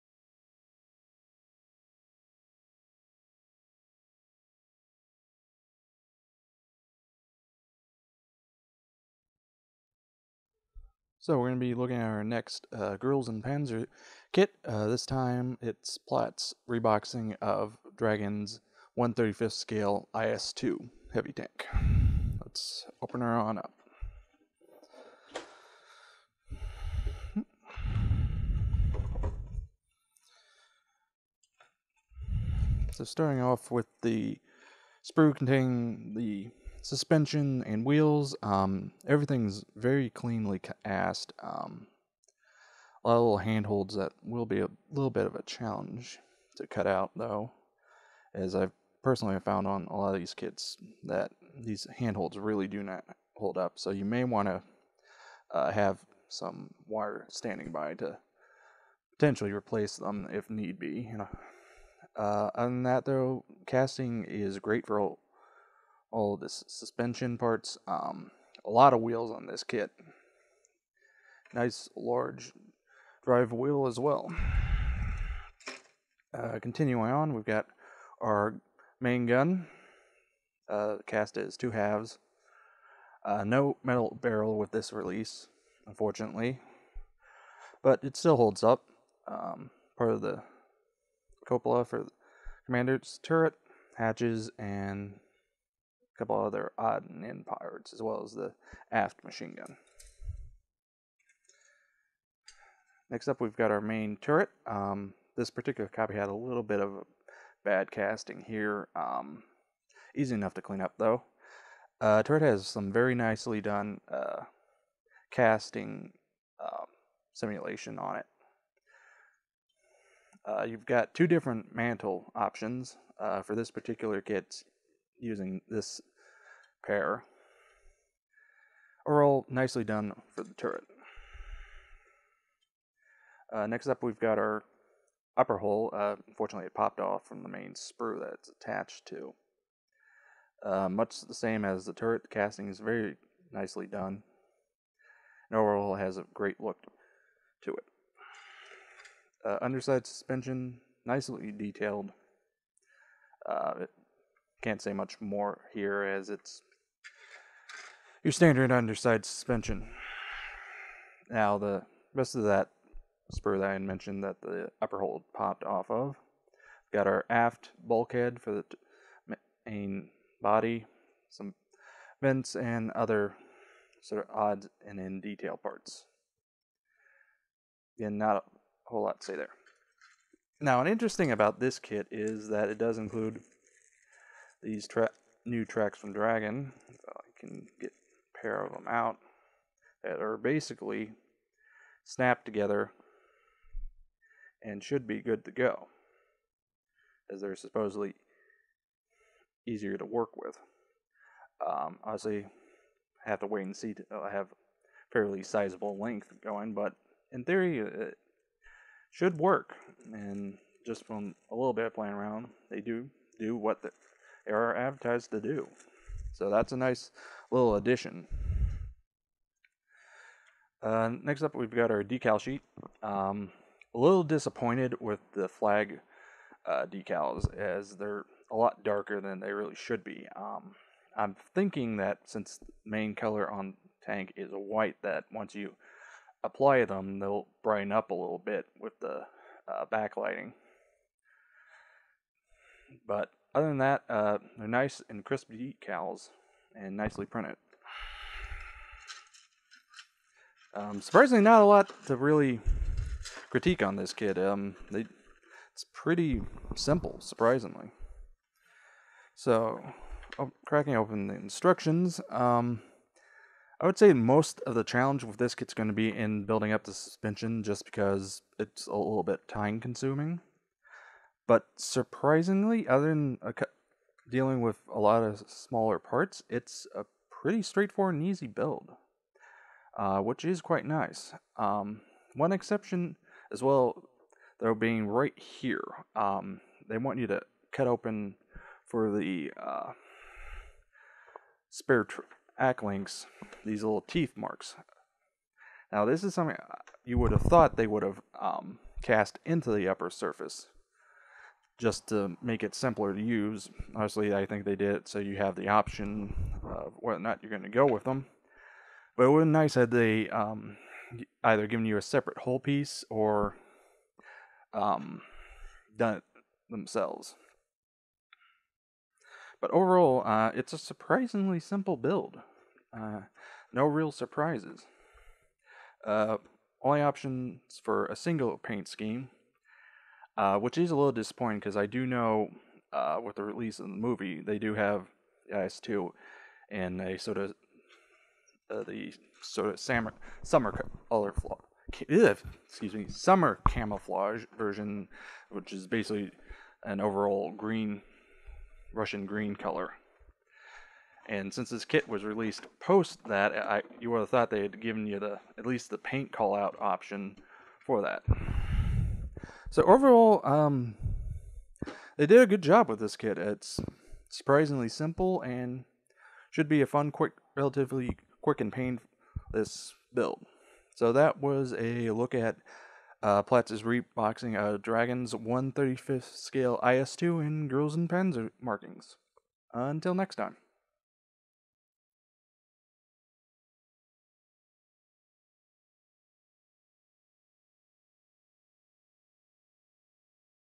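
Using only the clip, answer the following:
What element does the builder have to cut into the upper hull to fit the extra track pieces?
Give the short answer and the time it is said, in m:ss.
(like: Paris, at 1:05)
Teeth marks, at 4:54.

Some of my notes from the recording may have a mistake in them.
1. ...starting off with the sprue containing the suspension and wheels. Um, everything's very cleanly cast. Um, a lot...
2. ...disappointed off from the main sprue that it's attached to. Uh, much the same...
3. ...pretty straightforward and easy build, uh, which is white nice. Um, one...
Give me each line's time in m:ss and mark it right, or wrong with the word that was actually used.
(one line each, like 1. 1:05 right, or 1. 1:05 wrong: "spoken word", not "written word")
1. 0:33 right
2. 2:16 wrong: "popped", not "disappointed"
3. 4:37 wrong: "quite", not "white".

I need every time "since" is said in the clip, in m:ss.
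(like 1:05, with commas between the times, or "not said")
3:52, 5:51.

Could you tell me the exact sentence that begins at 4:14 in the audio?
Um, they, it's pretty simple, surprisingly.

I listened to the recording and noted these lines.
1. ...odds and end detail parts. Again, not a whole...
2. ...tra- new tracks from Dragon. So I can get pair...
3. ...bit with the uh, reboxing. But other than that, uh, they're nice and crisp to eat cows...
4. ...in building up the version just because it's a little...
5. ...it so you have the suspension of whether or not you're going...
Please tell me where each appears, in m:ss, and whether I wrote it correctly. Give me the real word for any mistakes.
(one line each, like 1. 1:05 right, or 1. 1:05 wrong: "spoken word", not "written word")
1. 2:54 right
2. 3:04 right
3. 3:58 wrong: "backlighting", not "reboxing"
4. 4:26 wrong: "suspension", not "version"
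5. 5:04 wrong: "option", not "suspension".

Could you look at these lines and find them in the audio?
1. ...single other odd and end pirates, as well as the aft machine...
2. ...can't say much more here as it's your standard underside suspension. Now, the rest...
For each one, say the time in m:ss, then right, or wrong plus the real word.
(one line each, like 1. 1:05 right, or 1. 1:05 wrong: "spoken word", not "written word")
1. 1:36 wrong: "couple", not "single"
2. 2:34 right.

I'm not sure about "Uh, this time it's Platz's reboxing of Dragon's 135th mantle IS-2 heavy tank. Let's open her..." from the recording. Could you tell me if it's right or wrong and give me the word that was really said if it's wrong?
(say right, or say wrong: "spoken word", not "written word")
wrong: "scale", not "mantle".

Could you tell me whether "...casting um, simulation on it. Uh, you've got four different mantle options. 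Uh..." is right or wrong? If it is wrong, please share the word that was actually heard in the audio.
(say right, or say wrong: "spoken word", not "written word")
wrong: "two", not "four".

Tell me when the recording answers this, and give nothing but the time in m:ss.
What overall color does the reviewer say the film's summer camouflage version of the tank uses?
5:48.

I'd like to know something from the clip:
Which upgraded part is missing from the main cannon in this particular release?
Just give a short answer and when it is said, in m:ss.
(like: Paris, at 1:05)
Metal barrel, at 1:23.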